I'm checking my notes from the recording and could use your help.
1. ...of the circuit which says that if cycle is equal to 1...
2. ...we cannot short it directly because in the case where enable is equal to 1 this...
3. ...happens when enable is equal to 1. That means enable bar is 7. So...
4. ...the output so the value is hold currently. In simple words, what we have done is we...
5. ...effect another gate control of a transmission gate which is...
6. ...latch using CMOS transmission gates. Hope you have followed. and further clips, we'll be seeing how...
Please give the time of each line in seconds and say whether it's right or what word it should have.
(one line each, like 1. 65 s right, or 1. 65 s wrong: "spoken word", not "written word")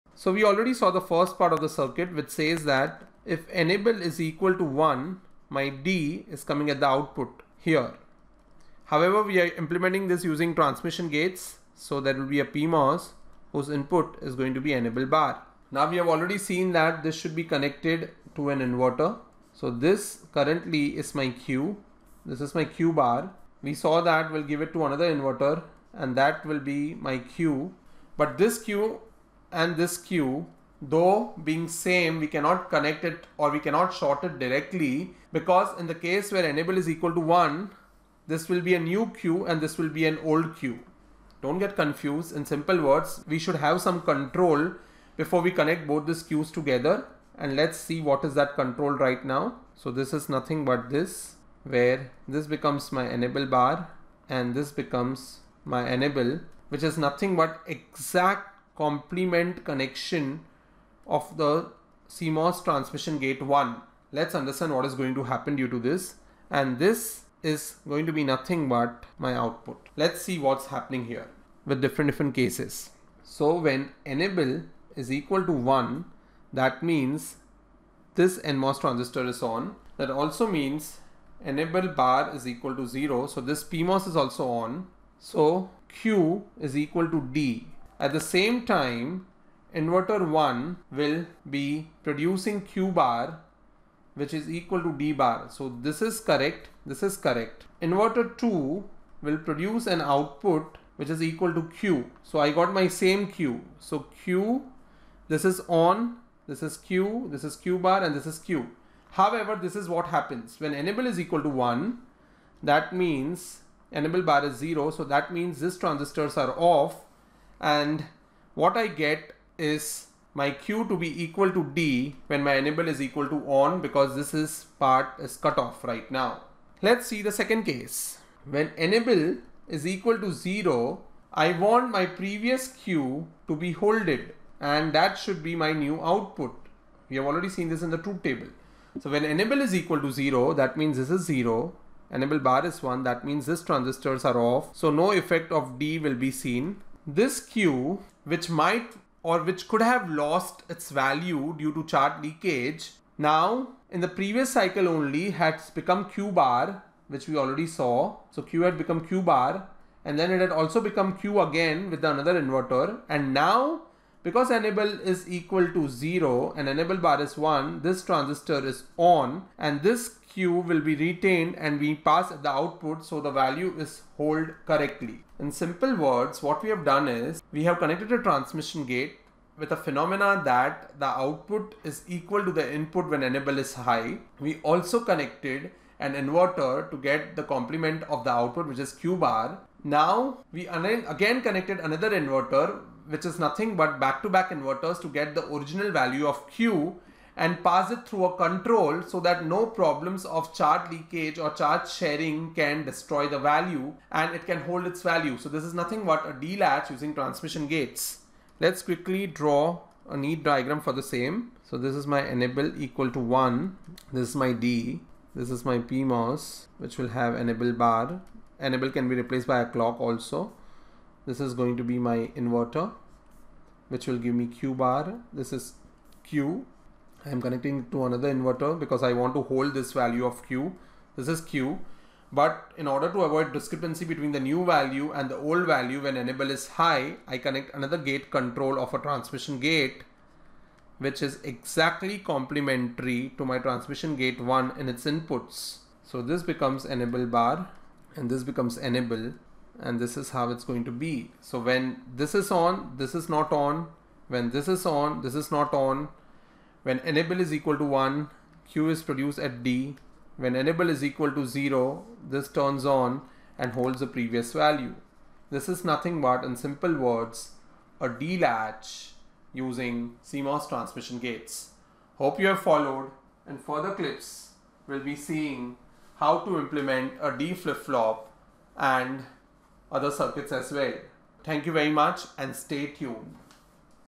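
1. 1 s wrong: "enable", not "cycle"
2. 33 s right
3. 110 s wrong: "0", not "7"
4. 172 s wrong: "correctly", not "currently"
5. 237 s wrong: "connect", not "effect"
6. 268 s right.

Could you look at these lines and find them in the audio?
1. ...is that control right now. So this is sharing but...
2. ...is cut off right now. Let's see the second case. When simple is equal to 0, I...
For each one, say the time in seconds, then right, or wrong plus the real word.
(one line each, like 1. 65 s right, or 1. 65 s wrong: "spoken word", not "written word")
1. 48 s wrong: "nothing", not "sharing"
2. 125 s wrong: "enable", not "simple".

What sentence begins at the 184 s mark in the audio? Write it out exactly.
We also connected an inverter to get the complement of the output which is Q bar.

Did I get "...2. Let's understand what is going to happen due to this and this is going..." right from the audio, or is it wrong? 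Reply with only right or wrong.
wrong.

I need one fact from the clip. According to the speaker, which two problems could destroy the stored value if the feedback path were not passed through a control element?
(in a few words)
Charge leakage or charge sharing.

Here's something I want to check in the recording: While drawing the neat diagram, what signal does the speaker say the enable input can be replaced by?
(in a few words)
A clock.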